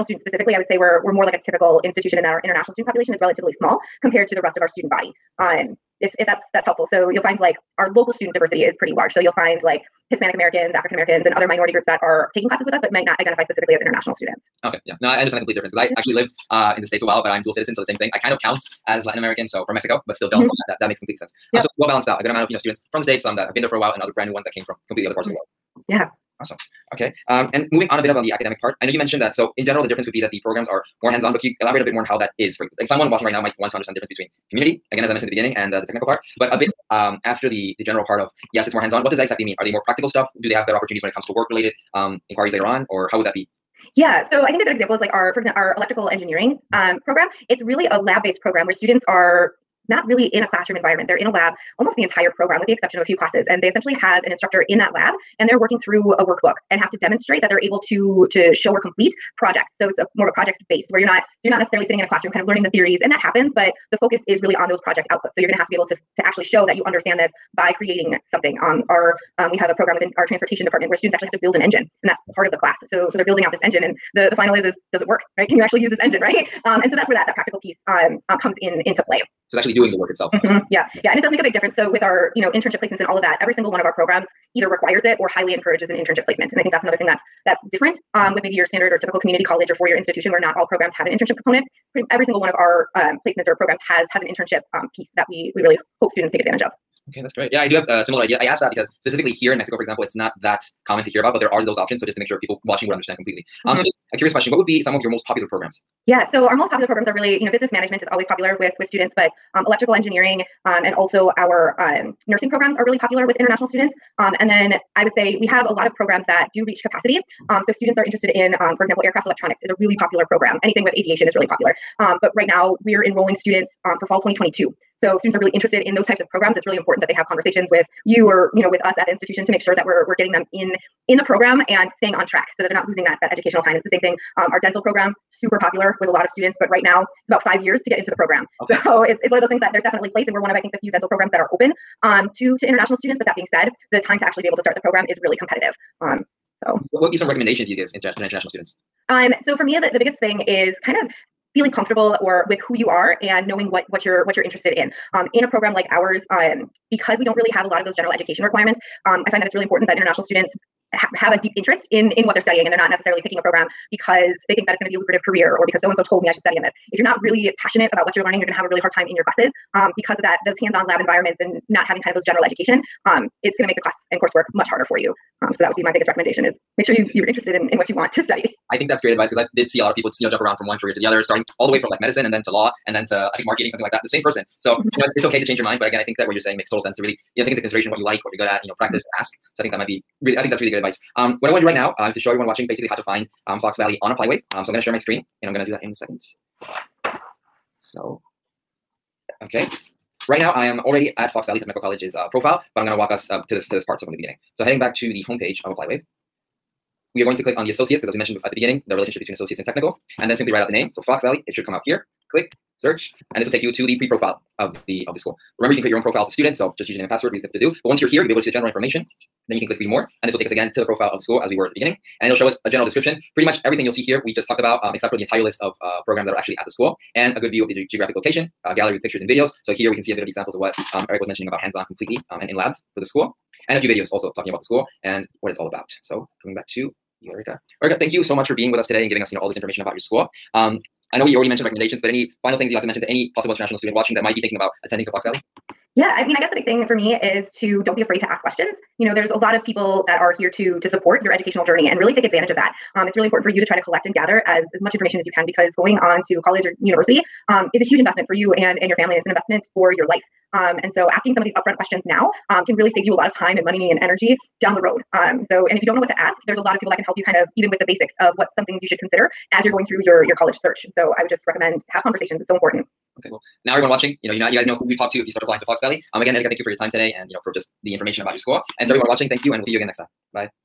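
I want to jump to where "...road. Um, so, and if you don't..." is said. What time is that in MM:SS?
04:24.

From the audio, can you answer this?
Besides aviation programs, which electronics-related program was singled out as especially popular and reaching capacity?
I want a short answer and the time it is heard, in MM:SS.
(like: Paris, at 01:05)
Aircraft electronics, at 01:59.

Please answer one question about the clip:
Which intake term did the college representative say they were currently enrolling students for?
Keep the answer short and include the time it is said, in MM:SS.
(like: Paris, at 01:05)
Fall 2022, at 02:04.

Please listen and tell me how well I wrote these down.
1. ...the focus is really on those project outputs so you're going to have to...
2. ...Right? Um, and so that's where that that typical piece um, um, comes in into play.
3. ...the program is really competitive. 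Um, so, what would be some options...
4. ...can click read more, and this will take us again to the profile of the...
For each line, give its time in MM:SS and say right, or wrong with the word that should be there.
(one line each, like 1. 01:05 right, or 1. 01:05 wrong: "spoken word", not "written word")
1. 01:03 right
2. 01:16 wrong: "practical", not "typical"
3. 02:24 wrong: "recommendations", not "options"
4. 03:39 right.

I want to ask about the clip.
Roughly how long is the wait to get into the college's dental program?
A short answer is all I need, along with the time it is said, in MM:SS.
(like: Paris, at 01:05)
About 5 years, at 02:17.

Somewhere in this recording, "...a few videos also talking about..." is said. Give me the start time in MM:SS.
03:53.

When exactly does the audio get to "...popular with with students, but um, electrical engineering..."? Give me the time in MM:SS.
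01:48.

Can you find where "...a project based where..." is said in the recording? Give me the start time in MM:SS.
01:00.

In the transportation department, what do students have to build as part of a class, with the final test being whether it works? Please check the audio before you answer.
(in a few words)
An engine.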